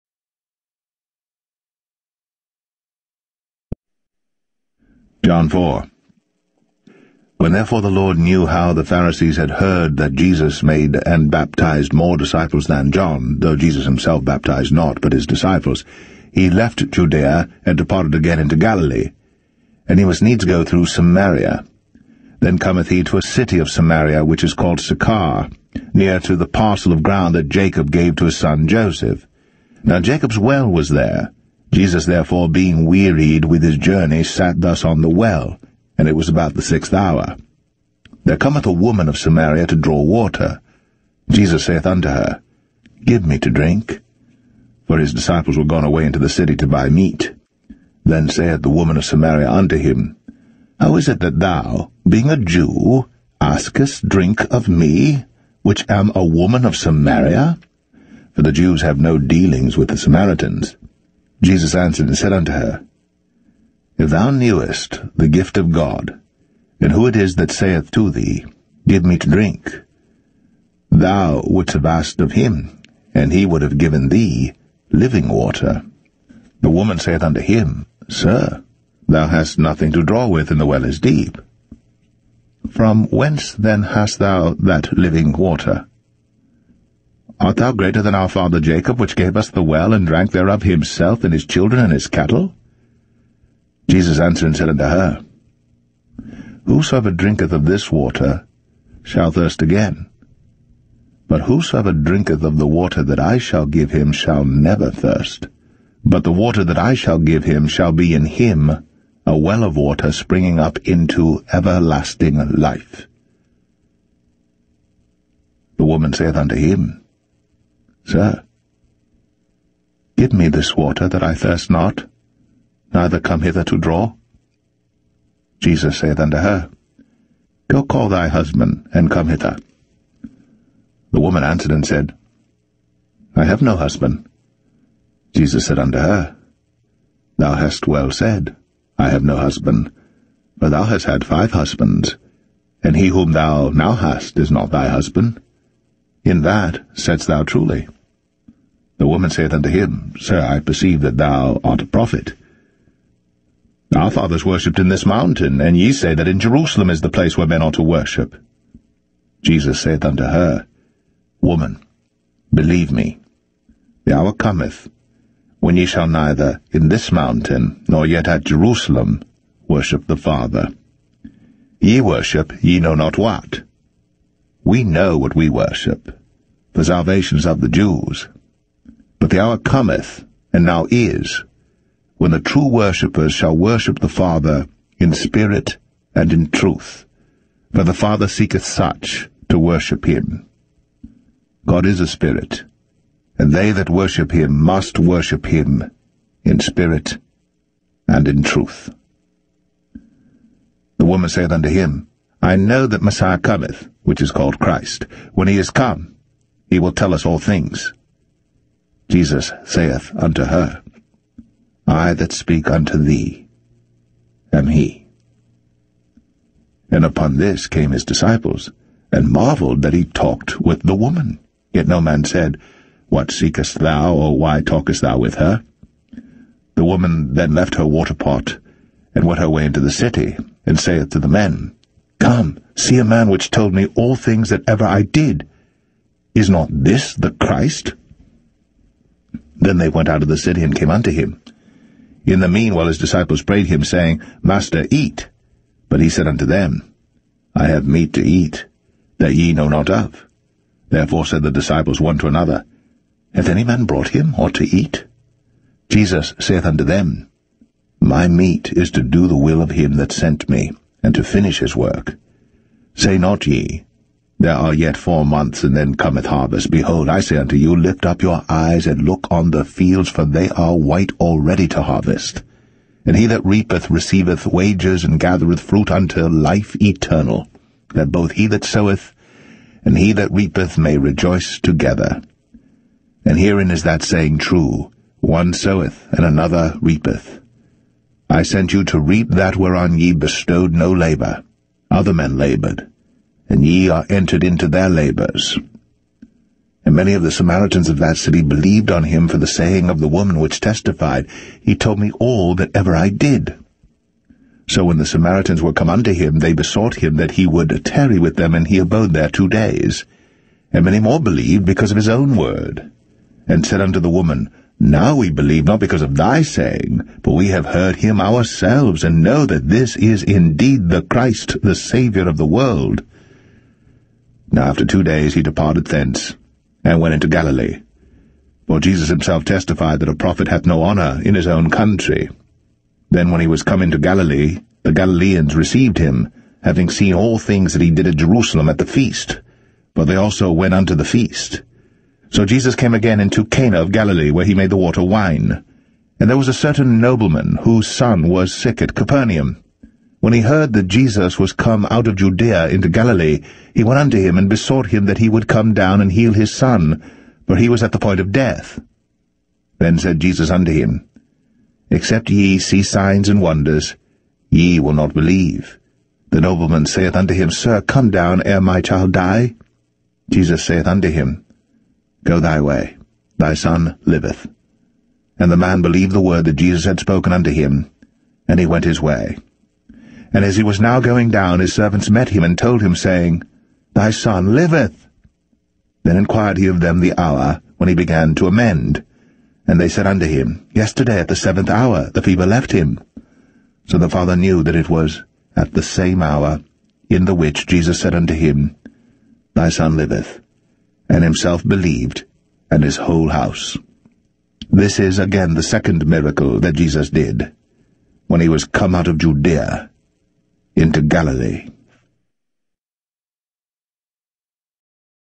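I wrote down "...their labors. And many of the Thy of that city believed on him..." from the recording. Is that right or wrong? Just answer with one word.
wrong.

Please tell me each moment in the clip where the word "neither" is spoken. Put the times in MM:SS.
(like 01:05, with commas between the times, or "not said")
02:02, 02:46.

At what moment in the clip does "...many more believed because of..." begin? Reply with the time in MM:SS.
05:10.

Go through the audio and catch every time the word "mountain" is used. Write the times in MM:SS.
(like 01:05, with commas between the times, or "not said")
02:35, 02:47.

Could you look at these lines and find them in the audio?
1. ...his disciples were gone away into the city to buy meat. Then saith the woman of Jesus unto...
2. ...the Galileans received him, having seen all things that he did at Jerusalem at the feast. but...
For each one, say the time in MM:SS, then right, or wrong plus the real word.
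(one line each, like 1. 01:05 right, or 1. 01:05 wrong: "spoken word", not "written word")
1. 00:44 wrong: "Samaria", not "Jesus"
2. 05:34 right.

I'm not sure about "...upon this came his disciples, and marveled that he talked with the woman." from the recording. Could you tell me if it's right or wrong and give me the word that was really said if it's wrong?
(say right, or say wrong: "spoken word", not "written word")
right.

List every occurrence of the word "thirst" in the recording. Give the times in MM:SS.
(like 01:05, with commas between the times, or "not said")
01:39, 01:44, 02:01.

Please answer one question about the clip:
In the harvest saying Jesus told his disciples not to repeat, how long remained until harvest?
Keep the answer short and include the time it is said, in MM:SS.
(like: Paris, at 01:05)
4 months, at 04:24.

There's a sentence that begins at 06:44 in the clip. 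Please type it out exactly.
This is again the second miracle that Jesus did, when he was come out of Judea into Galilee.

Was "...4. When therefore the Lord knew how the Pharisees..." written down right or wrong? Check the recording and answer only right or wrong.
right.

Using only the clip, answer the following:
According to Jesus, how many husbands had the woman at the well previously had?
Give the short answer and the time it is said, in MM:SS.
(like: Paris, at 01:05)
5, at 02:21.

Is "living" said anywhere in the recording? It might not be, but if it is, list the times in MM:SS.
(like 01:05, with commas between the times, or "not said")
01:14, 01:24.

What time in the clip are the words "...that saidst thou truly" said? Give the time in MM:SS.
02:26.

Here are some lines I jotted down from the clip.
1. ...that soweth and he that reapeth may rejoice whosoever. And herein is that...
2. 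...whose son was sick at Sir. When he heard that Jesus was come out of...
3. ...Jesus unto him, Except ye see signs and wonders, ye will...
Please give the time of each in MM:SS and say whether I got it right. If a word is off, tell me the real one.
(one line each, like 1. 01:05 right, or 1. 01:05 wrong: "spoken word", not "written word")
1. 04:38 wrong: "together", not "whosoever"
2. 05:47 wrong: "Capernaum", not "Sir"
3. 06:00 right.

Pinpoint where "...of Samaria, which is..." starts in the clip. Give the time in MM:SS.
00:23.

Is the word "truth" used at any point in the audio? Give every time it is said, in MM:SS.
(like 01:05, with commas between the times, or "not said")
03:06, 03:18.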